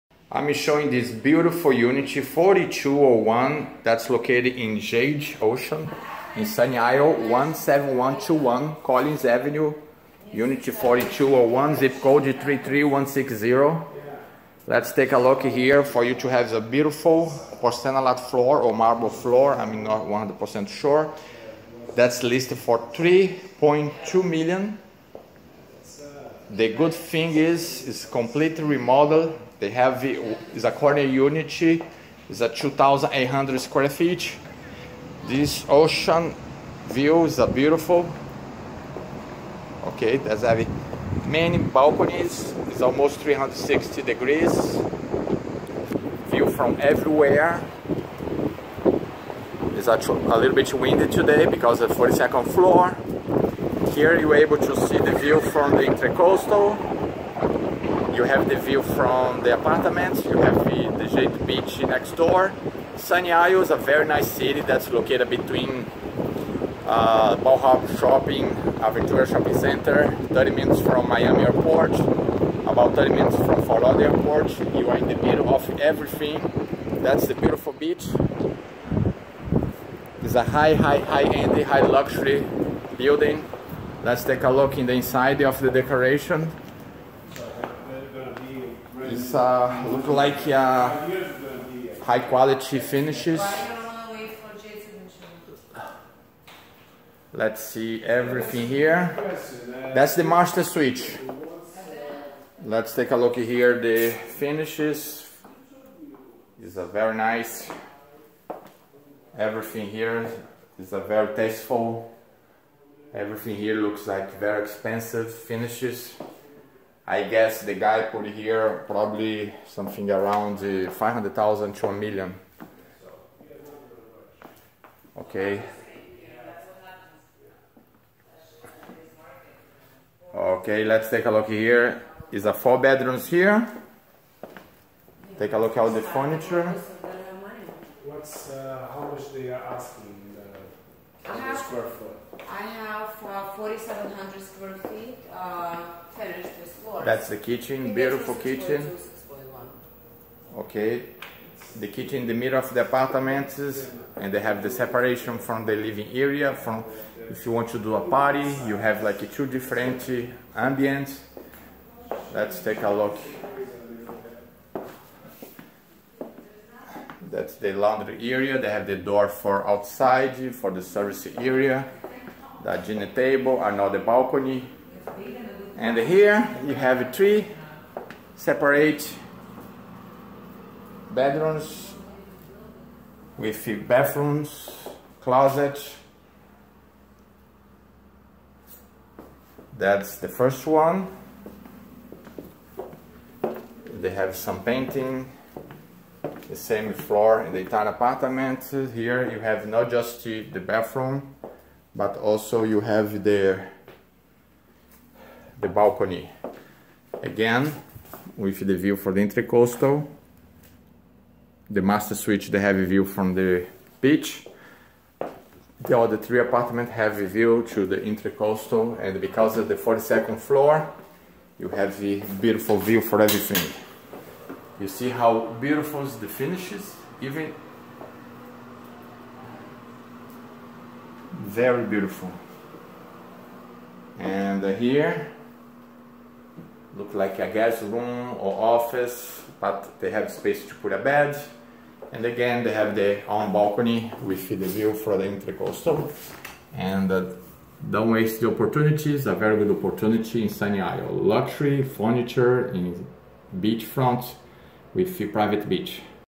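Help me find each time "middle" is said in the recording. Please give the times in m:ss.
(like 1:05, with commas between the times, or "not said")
1:15, 2:32.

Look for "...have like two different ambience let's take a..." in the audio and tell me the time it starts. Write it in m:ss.
2:38.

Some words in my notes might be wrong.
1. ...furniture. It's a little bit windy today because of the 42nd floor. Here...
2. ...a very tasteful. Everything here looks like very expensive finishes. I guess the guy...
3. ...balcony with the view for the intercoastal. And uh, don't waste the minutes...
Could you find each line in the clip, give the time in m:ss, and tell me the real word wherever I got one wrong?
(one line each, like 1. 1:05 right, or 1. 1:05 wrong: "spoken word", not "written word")
1. 0:46 wrong: "everywhere", not "furniture"
2. 1:50 right
3. 4:03 wrong: "opportunities", not "minutes".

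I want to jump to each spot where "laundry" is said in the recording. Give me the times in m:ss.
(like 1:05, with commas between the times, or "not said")
2:47.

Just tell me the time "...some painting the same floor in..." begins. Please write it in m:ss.
3:14.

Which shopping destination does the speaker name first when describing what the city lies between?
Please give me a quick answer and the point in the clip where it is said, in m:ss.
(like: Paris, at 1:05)
Bal Harbour Shopping, at 1:07.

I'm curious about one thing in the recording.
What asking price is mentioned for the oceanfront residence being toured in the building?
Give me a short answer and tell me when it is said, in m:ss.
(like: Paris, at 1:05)
$3.2 million, at 0:22.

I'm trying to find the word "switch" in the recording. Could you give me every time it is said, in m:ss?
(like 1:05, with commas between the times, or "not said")
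1:40, 3:32.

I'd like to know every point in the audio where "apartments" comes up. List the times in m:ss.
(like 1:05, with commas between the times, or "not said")
0:59, 2:32, 3:17, 3:36.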